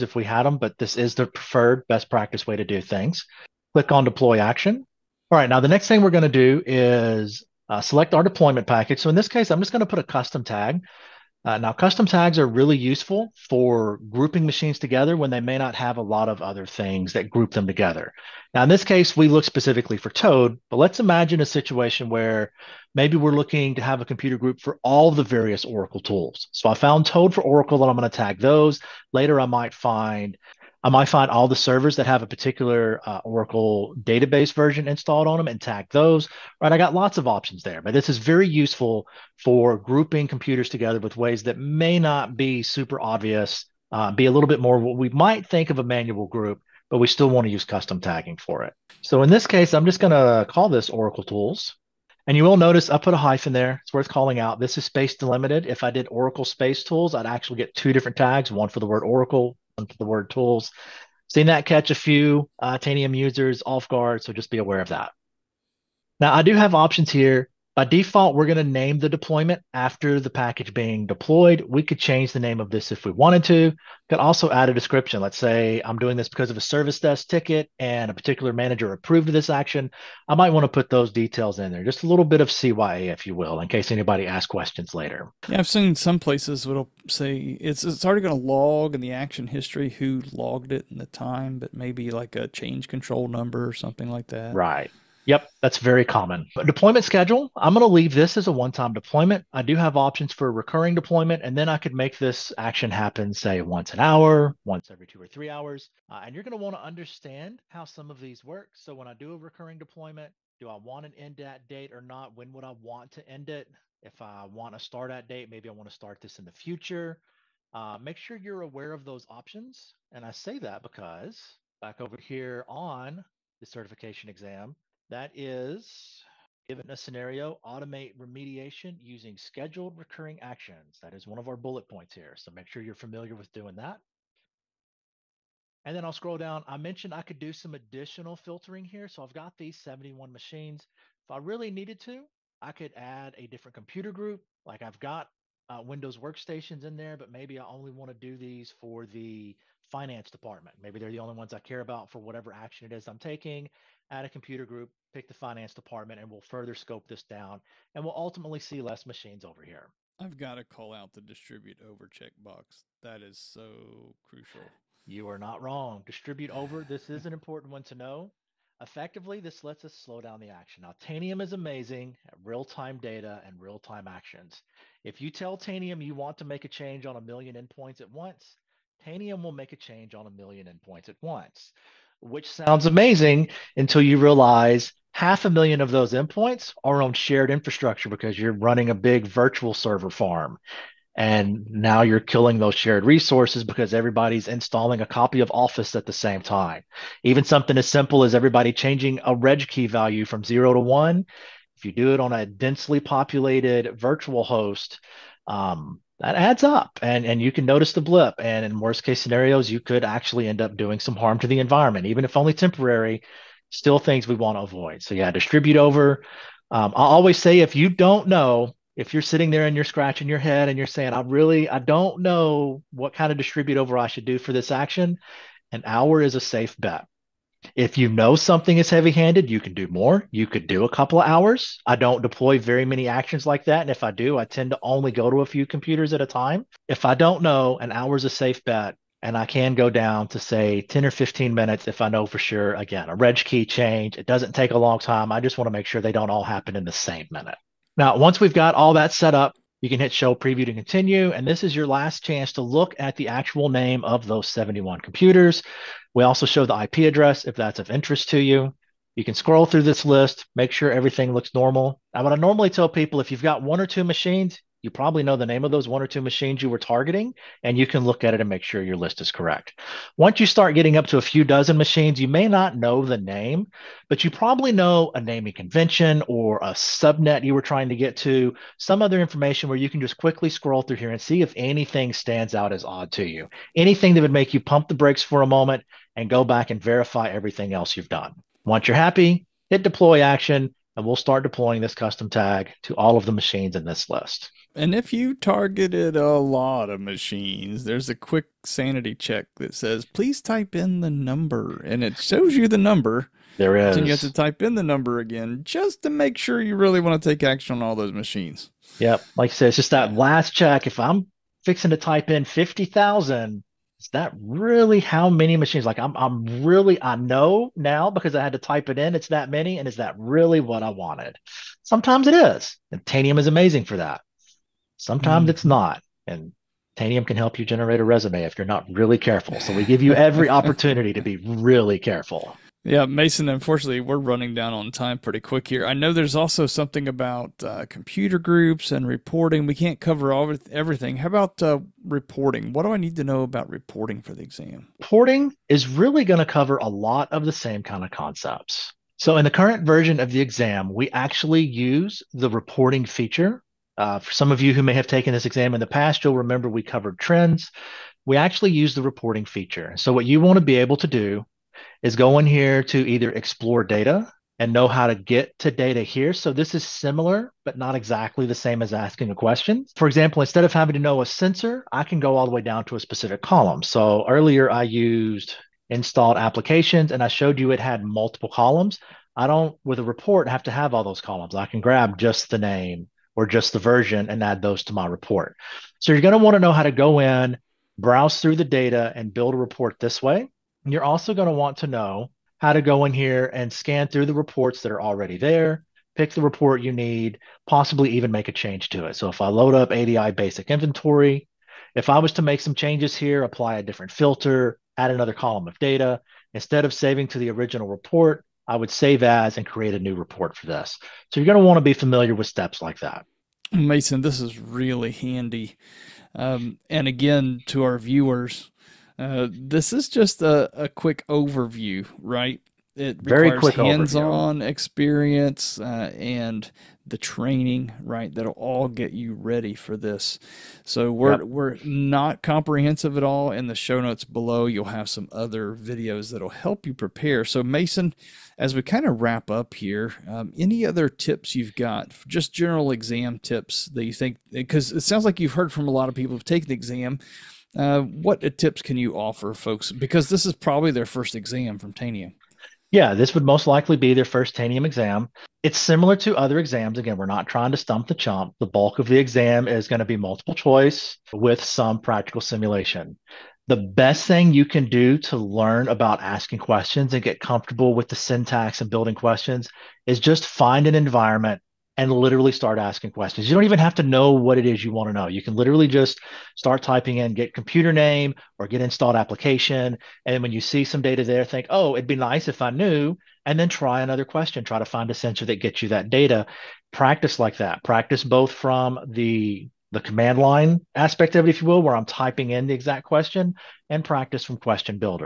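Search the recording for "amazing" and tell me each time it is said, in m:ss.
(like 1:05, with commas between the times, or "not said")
2:51, 3:02, 5:23.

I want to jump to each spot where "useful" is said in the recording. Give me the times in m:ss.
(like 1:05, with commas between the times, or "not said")
0:12, 0:38.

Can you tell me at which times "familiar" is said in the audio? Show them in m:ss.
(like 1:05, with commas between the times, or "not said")
2:12, 6:51.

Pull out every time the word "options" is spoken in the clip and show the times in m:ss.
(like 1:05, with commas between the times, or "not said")
0:37, 1:06, 1:39, 1:59.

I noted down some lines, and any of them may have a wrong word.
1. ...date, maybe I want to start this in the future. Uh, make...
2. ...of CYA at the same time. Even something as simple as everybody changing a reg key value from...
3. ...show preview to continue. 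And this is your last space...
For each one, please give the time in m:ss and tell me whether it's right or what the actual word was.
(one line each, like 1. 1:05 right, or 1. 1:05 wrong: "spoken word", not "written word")
1. 1:55 right
2. 3:15 wrong: "Office", not "CYA"
3. 4:10 wrong: "chance", not "space".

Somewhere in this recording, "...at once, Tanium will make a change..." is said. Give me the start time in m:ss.
2:58.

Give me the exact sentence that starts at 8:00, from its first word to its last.
And when you see some data there, think, oh, it'd be nice if I knew.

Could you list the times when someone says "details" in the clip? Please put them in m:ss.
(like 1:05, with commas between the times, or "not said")
1:21.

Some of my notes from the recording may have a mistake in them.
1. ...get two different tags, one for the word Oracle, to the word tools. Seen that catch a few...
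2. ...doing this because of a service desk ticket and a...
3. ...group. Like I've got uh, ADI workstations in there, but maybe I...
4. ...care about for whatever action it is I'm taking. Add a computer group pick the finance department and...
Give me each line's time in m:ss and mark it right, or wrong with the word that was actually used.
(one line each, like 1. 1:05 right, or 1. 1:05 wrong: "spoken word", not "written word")
1. 0:57 right
2. 1:15 right
3. 2:24 wrong: "Windows", not "ADI"
4. 2:31 right.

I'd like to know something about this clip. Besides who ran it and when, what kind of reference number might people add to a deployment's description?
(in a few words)
change control number.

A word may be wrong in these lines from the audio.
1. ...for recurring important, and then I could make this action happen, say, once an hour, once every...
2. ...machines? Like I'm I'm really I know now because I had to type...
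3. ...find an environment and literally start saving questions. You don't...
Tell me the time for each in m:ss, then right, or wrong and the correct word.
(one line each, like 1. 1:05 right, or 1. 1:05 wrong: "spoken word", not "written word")
1. 1:40 wrong: "deployment", not "important"
2. 5:15 right
3. 7:50 wrong: "asking", not "saving".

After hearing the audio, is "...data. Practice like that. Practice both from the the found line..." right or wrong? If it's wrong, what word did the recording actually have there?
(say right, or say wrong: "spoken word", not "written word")
wrong: "command", not "found".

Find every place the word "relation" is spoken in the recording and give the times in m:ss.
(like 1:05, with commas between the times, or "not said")
not said.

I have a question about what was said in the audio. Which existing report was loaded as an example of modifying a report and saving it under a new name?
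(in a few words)
ADI basic inventory.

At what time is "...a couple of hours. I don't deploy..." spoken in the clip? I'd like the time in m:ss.
3:50.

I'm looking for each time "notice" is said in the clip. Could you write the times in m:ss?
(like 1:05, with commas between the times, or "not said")
0:52, 3:27.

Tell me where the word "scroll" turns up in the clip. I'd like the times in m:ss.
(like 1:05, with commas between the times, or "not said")
2:16, 4:19, 4:40.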